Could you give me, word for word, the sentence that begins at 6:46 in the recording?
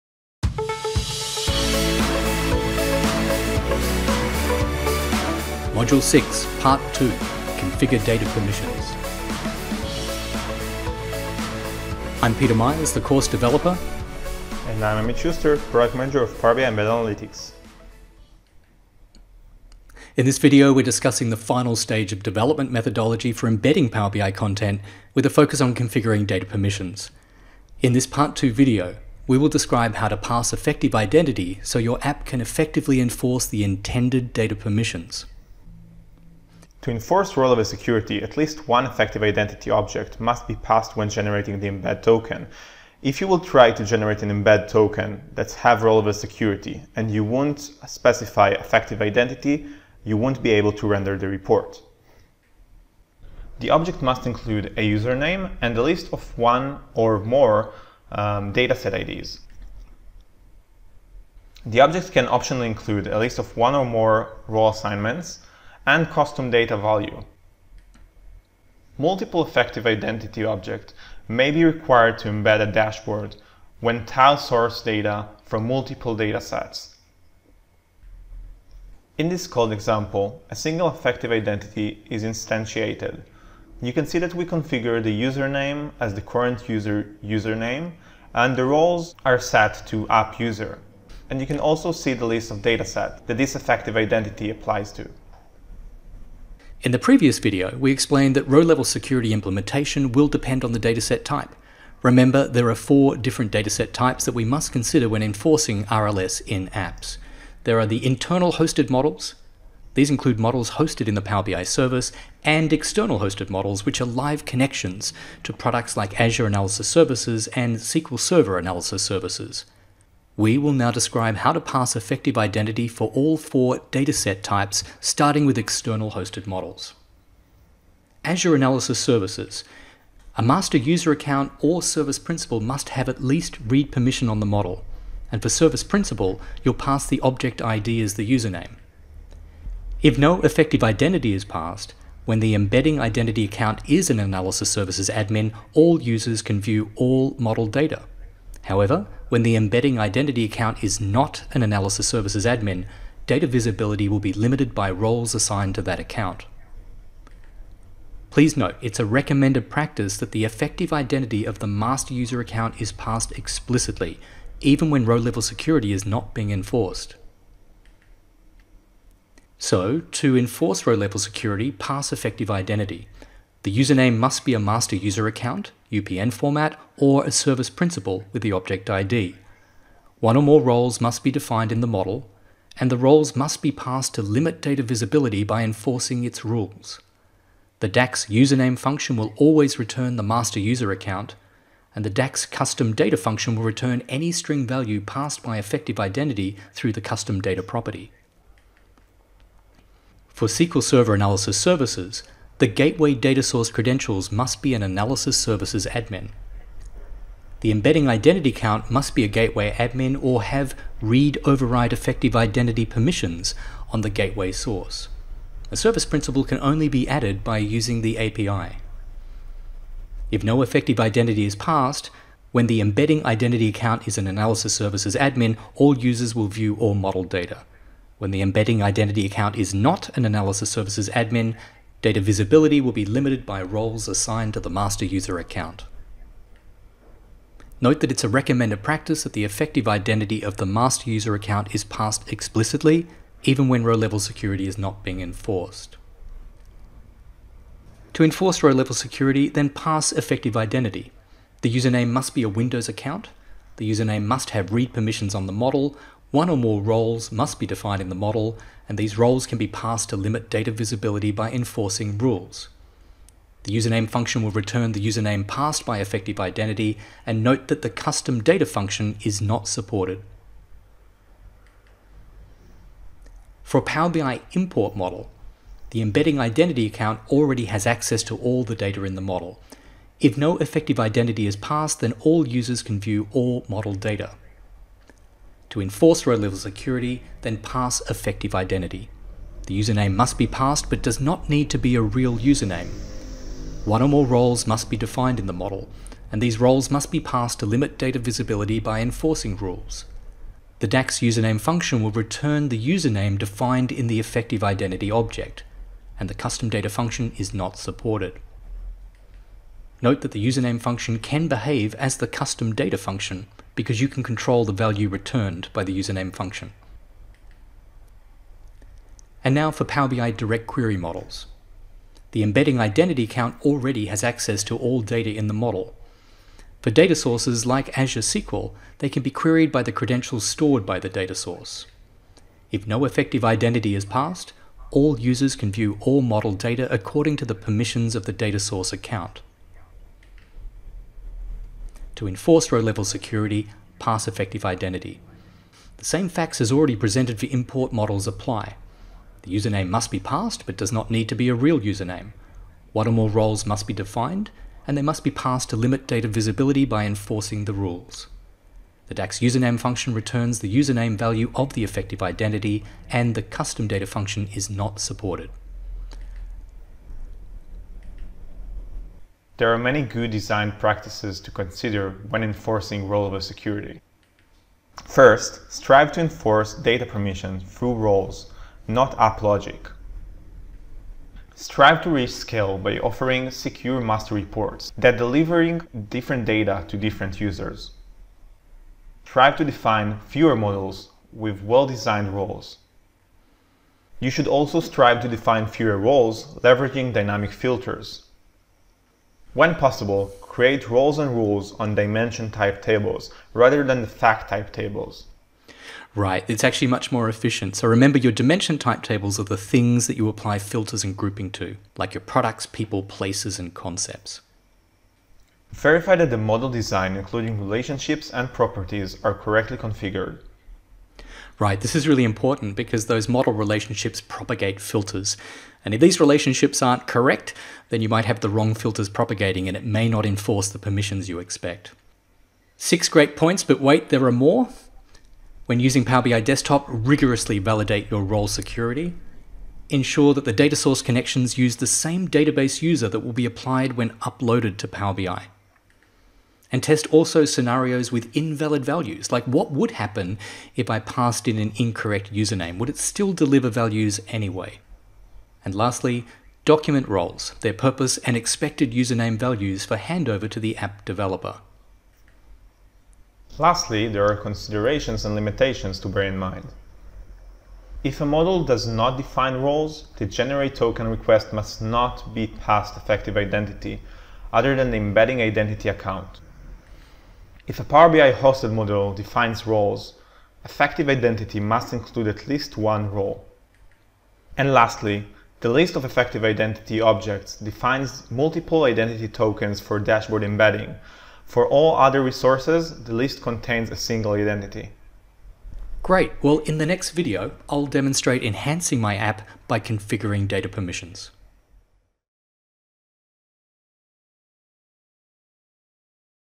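Right, it's actually much more efficient.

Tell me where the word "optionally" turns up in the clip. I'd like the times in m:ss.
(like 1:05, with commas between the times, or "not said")
1:02.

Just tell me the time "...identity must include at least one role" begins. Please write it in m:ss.
8:01.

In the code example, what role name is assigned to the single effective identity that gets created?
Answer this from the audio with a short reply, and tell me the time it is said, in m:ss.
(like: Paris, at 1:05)
app user, at 1:30.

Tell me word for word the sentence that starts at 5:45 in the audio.
The same facts as already presented for import models apply.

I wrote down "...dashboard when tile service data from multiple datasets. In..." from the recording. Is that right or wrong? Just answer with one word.
wrong.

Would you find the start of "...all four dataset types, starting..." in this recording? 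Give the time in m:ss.
2:03.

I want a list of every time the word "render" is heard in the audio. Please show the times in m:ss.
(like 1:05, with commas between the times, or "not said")
0:50.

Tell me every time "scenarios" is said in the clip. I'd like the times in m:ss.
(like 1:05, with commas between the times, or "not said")
7:27.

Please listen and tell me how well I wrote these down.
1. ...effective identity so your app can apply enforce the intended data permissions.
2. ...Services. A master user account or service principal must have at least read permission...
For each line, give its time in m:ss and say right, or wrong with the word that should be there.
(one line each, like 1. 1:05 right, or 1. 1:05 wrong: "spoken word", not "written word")
1. 0:30 wrong: "effectively", not "apply"
2. 2:08 right.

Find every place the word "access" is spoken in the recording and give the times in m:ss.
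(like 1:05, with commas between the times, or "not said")
4:37, 5:24.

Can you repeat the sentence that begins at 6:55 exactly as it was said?
Verify that the model design, including relationships and properties, are correctly configured.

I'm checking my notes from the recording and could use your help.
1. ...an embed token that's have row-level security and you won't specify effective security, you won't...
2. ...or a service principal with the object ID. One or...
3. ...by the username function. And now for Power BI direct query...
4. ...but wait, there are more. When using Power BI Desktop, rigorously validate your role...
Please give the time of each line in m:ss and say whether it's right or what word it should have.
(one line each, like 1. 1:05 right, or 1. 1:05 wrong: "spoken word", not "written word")
1. 0:44 wrong: "identity", not "security"
2. 2:56 right
3. 5:15 right
4. 7:13 right.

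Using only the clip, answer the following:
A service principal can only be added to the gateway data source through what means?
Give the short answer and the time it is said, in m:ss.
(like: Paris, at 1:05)
the API, at 3:38.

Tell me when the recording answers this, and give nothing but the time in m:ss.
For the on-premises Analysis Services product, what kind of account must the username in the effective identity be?
4:12.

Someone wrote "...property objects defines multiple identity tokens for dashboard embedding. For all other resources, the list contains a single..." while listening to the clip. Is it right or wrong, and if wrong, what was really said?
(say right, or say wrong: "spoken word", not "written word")
wrong: "identity", not "property".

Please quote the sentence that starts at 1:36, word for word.
In the previous video, we explained that row-level security implementation will depend on the dataset type.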